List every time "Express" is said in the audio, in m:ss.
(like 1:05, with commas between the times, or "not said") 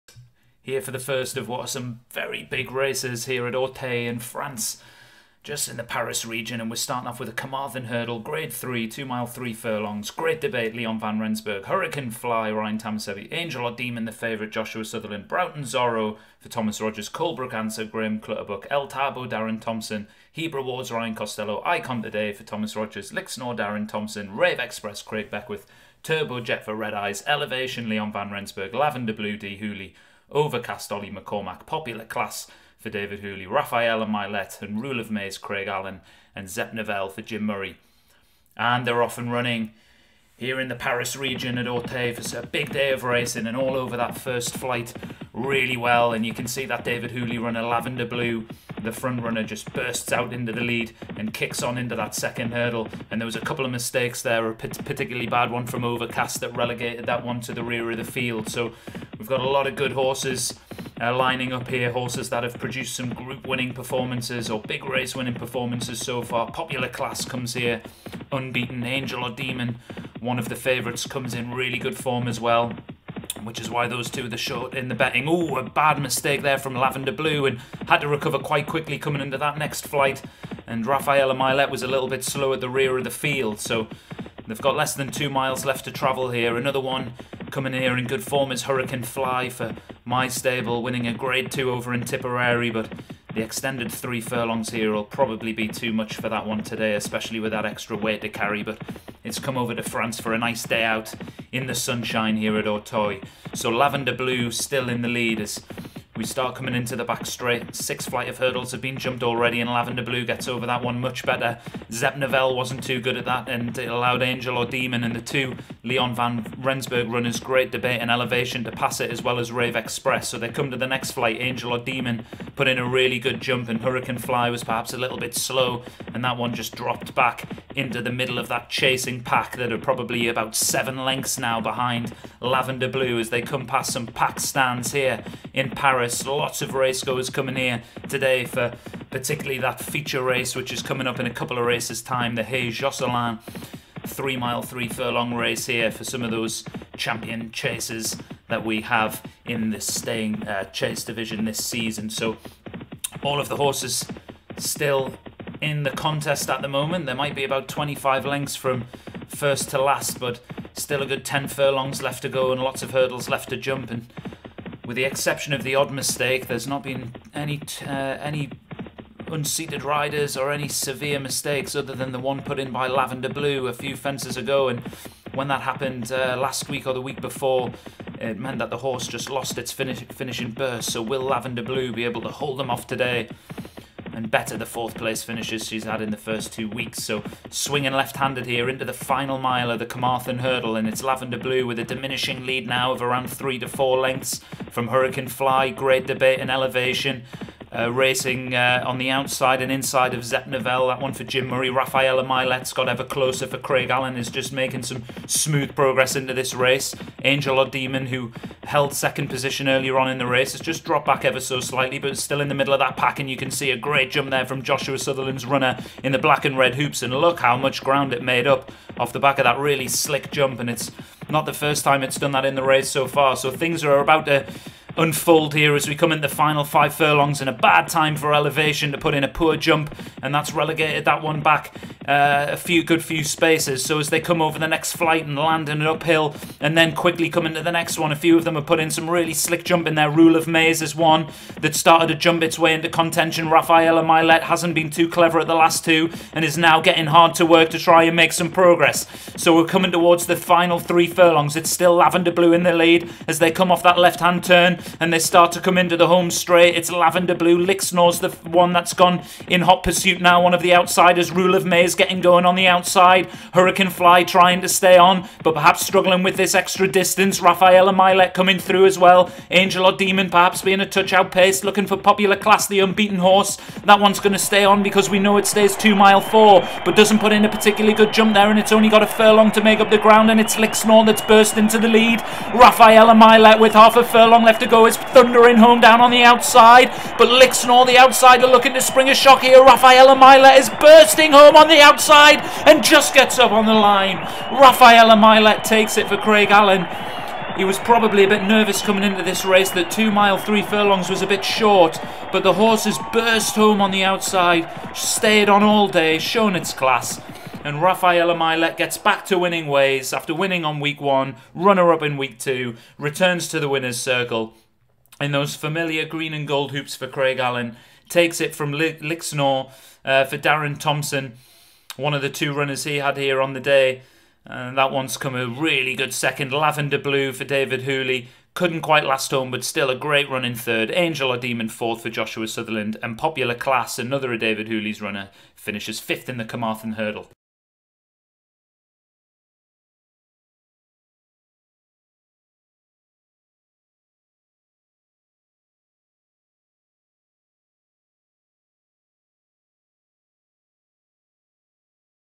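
0:24, 1:59.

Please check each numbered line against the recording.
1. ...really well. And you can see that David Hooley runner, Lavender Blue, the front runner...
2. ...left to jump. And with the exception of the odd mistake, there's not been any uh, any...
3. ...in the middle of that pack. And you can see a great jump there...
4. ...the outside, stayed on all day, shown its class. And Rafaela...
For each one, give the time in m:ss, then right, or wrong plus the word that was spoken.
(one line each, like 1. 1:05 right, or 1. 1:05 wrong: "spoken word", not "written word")
1. 0:45 right
2. 2:43 right
3. 3:32 right
4. 5:03 right.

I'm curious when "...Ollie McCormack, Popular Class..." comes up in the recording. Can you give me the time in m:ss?
0:30.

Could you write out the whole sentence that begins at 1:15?
Oh, a bad mistake there from Lavender Blue and had to recover quite quickly coming into that next flight.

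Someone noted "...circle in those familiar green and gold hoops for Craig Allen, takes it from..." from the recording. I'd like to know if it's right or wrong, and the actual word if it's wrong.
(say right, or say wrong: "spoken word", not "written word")
right.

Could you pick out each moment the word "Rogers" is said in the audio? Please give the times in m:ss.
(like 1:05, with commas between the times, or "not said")
0:16, 0:22.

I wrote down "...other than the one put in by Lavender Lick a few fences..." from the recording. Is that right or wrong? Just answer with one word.
wrong.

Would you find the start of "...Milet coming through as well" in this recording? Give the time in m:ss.
4:27.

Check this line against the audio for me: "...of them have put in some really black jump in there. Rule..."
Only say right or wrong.
wrong.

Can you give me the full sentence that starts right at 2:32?
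So all of the horses still in the contest at the moment.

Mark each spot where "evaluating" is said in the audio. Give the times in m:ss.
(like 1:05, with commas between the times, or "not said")
not said.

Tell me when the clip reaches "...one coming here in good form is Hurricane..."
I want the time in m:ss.
1:26.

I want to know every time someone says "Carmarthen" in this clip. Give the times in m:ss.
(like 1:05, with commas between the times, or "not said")
0:07, 3:09, 5:36.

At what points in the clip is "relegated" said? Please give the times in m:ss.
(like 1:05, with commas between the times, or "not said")
0:56, 3:50.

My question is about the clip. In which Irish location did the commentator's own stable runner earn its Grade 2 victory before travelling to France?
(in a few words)
Tipperary.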